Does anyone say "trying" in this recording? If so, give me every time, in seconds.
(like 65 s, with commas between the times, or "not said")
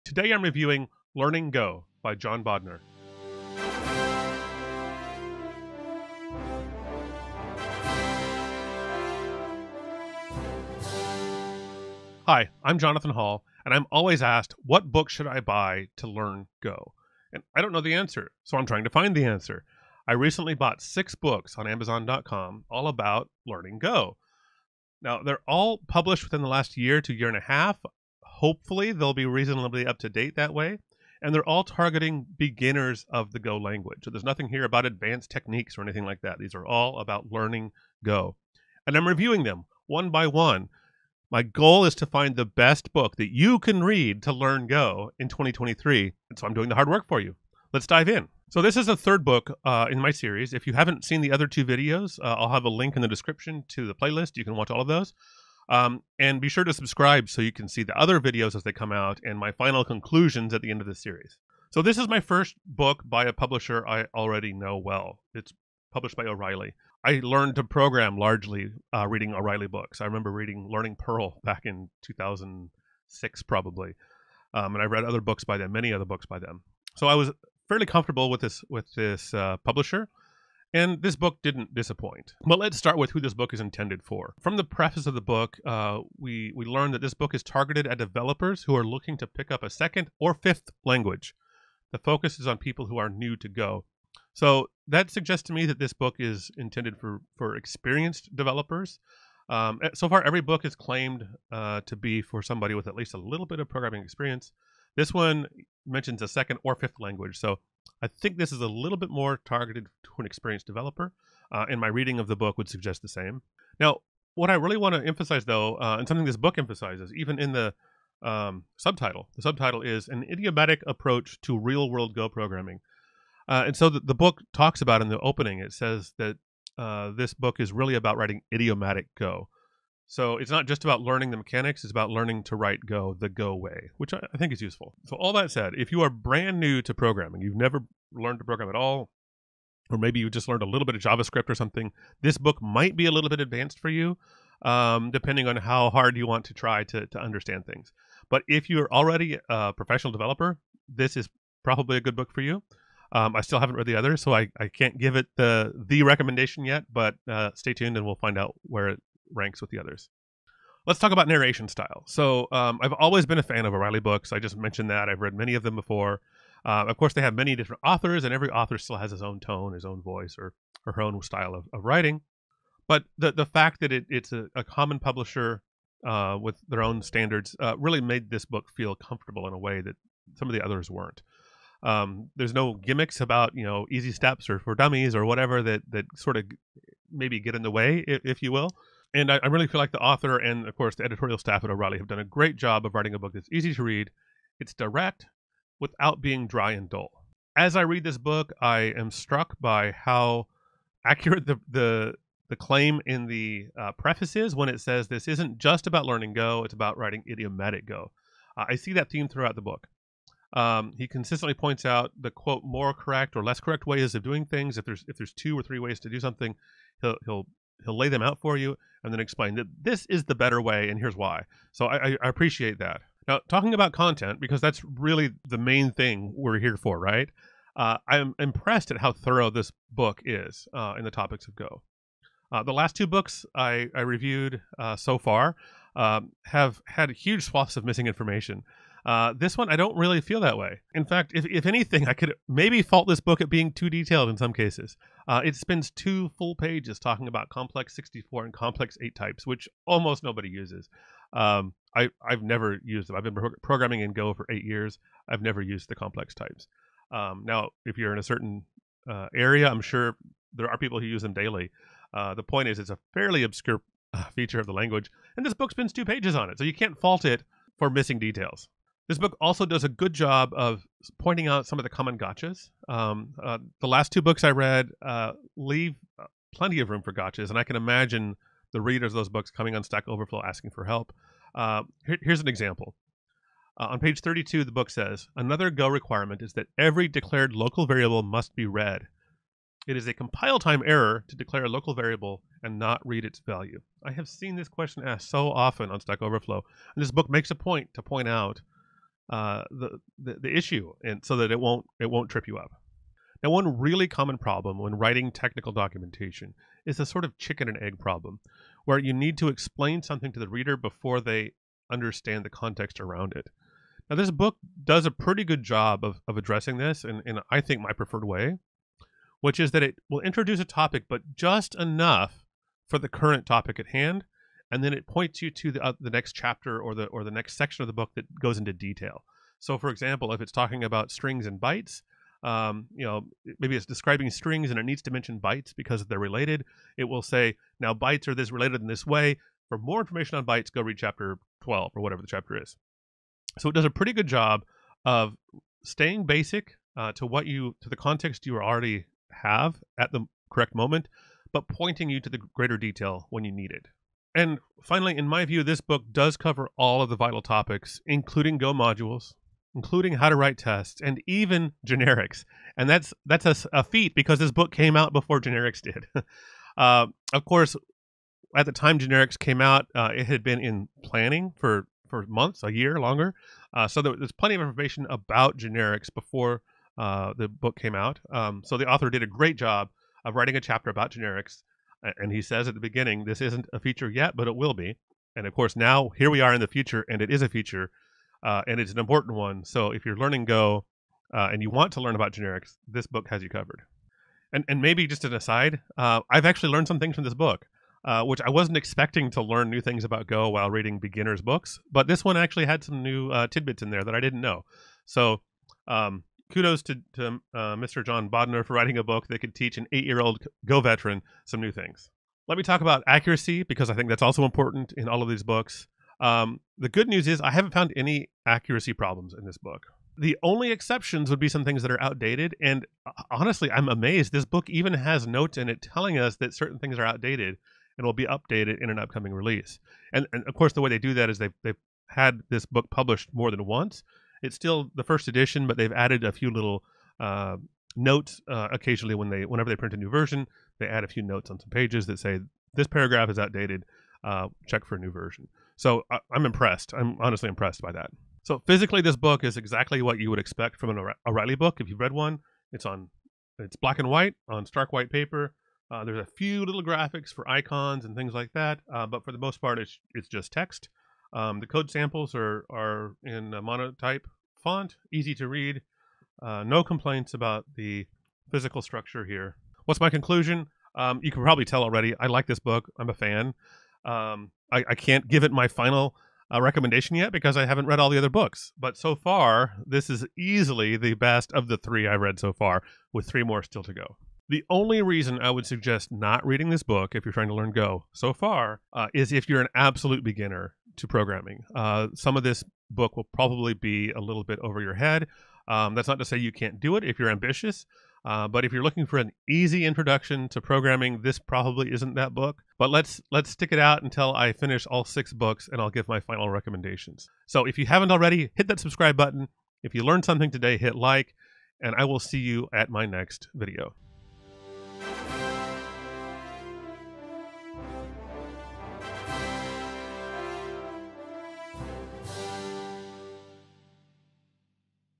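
18 s, 487 s.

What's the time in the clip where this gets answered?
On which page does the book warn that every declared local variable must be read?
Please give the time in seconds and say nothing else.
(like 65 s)
283 s.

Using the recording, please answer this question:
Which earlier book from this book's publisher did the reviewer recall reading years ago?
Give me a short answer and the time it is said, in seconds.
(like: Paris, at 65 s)
Learning Perl, at 70 s.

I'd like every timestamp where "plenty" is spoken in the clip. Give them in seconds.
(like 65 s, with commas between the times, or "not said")
276 s, 374 s.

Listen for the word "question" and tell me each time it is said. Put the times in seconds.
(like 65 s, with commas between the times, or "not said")
294 s.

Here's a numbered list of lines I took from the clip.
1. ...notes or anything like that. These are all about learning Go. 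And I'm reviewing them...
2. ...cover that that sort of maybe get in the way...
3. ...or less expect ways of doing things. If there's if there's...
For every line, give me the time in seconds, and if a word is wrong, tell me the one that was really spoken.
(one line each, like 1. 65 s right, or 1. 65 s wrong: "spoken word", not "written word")
1. 35 s wrong: "techniques", not "notes"
2. 185 s wrong: "whatever", not "cover"
3. 213 s wrong: "correct", not "expect".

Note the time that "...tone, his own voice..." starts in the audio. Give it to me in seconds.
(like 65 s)
169 s.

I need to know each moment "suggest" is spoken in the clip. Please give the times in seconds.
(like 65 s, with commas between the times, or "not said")
95 s, 112 s, 485 s.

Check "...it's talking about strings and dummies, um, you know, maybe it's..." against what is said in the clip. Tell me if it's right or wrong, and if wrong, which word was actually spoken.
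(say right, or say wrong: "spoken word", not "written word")
wrong: "bytes", not "dummies".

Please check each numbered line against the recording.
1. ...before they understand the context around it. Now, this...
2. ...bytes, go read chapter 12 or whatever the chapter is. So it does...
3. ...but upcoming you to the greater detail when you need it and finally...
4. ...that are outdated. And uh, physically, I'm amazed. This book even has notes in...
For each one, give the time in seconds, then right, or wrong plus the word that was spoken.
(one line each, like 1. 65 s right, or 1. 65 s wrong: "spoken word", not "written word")
1. 310 s right
2. 340 s right
3. 351 s wrong: "pointing", not "upcoming"
4. 421 s wrong: "honestly", not "physically".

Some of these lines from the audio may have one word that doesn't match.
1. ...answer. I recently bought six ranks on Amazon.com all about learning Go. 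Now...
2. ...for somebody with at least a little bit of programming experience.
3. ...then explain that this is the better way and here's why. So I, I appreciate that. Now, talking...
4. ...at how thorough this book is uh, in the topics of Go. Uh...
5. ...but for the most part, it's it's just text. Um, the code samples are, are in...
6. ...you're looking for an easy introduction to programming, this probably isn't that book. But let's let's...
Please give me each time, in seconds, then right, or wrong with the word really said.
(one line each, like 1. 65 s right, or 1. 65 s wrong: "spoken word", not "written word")
1. 19 s wrong: "books", not "ranks"
2. 102 s right
3. 219 s right
4. 228 s right
5. 459 s right
6. 498 s right.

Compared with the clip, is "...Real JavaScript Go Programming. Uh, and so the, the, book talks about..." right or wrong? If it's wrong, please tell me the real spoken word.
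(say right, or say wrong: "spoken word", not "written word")
wrong: "World", not "JavaScript".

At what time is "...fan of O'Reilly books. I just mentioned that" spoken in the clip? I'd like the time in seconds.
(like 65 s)
163 s.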